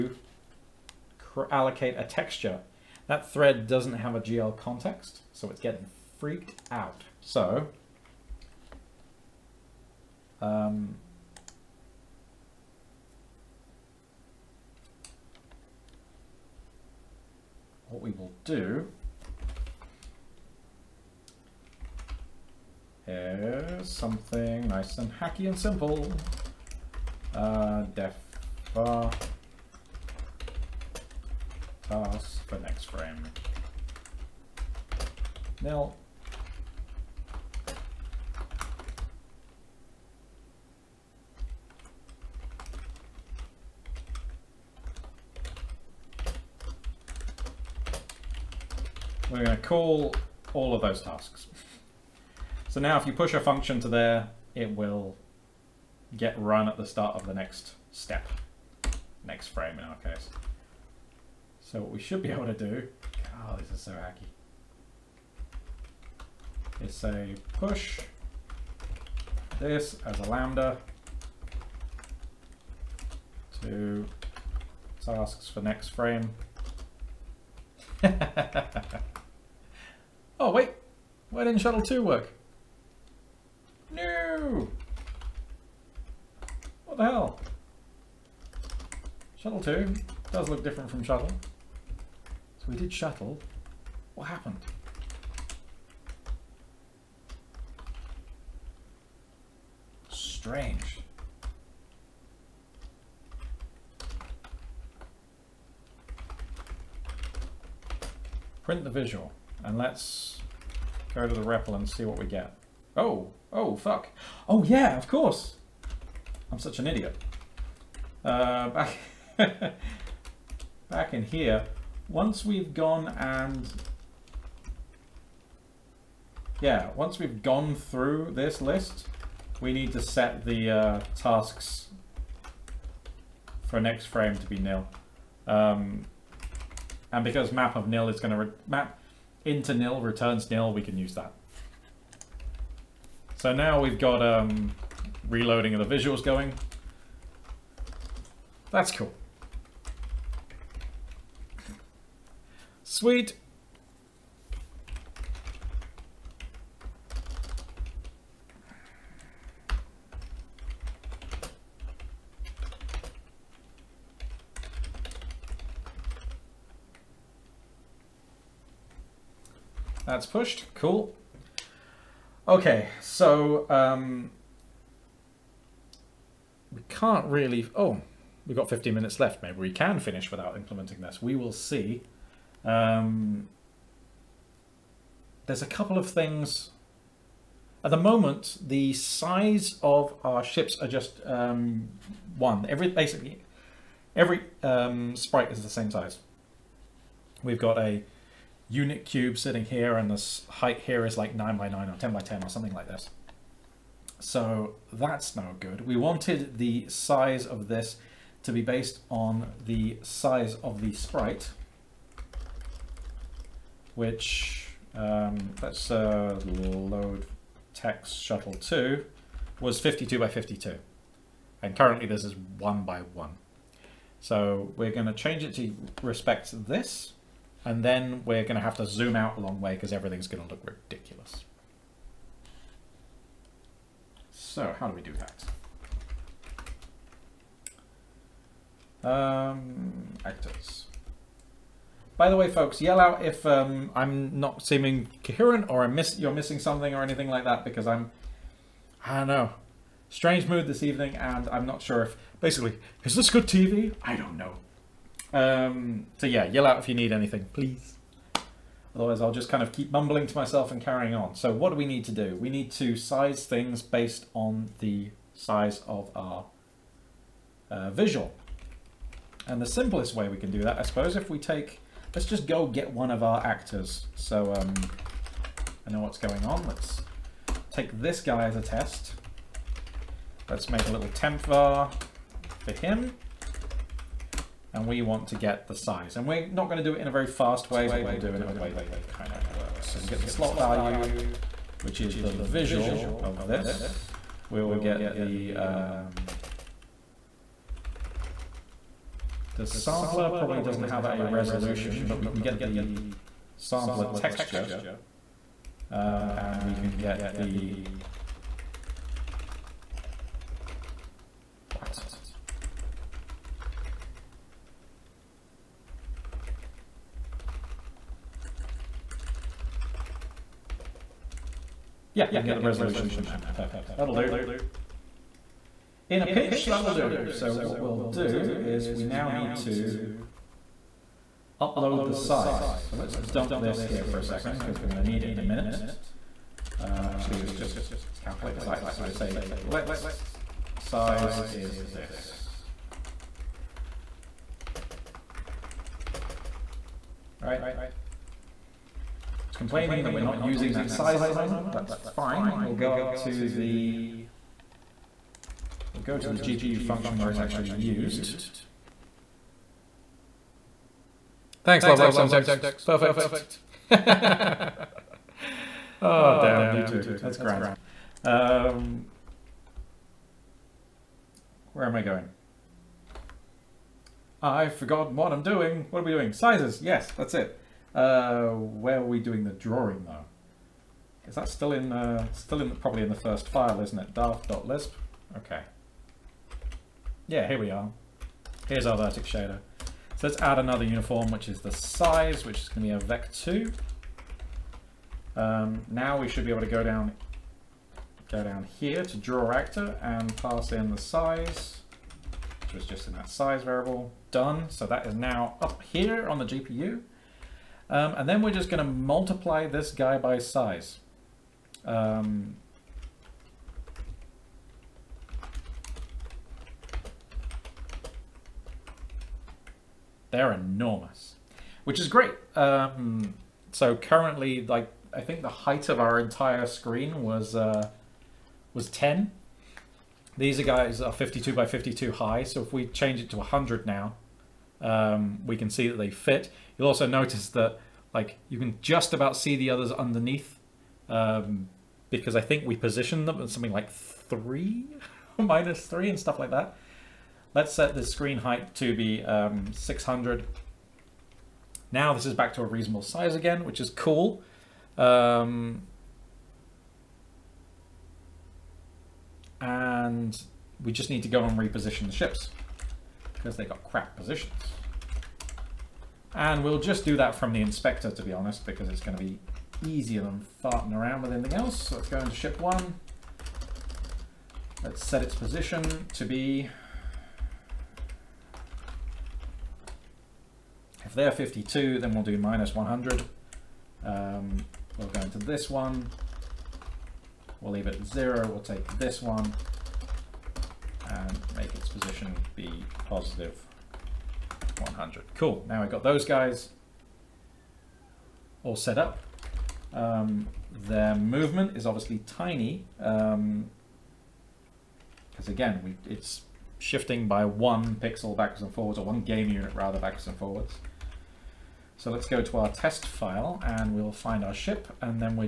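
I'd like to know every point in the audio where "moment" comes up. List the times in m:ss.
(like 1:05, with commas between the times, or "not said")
3:07, 5:51.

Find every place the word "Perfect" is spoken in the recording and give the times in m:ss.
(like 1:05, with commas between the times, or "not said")
5:23, 6:02.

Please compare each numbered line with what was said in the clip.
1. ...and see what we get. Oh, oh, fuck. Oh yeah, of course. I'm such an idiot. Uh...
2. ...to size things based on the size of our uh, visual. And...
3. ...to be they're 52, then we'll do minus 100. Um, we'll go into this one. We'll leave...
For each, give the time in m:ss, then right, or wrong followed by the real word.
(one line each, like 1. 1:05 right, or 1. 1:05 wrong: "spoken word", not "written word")
1. 1:51 right
2. 4:22 right
3. 7:56 right.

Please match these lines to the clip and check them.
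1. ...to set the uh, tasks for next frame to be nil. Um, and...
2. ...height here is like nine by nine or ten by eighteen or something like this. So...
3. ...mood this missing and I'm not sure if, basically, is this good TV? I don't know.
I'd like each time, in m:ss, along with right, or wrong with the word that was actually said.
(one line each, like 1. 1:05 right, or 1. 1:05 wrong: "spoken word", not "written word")
1. 2:09 right
2. 3:20 wrong: "ten", not "eighteen"
3. 4:10 wrong: "evening", not "missing".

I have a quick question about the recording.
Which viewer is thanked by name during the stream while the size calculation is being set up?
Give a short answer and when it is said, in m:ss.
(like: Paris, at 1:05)
Love Life Semtex, at 6:01.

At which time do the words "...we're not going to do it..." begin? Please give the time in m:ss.
4:46.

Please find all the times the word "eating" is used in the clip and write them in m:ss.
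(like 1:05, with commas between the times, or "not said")
not said.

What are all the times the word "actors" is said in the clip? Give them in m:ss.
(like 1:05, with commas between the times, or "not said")
4:00, 4:33, 6:39.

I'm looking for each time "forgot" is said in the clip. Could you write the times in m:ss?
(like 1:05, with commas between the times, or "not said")
6:14.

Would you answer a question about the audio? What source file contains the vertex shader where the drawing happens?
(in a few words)
Daft.lisp.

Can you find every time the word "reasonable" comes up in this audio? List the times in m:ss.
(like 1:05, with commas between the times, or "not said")
7:32.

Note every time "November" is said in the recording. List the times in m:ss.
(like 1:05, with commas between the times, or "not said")
not said.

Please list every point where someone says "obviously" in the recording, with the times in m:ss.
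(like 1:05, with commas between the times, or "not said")
8:21.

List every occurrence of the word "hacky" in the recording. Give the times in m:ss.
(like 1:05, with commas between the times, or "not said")
0:25, 1:03.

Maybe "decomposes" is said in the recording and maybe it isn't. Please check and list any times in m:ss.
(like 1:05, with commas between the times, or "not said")
not said.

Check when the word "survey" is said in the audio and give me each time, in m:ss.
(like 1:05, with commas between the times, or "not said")
not said.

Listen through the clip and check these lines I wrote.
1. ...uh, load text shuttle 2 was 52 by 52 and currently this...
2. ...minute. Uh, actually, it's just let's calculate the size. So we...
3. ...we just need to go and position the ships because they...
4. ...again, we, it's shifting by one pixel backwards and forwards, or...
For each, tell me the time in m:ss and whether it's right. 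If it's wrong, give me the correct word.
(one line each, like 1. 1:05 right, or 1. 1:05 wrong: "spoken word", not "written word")
1. 3:35 right
2. 5:35 right
3. 7:40 wrong: "reposition", not "position"
4. 8:25 right.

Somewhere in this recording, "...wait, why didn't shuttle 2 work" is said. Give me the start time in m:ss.
1:20.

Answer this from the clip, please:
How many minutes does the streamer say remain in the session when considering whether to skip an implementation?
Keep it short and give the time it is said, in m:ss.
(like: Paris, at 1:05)
15, at 2:58.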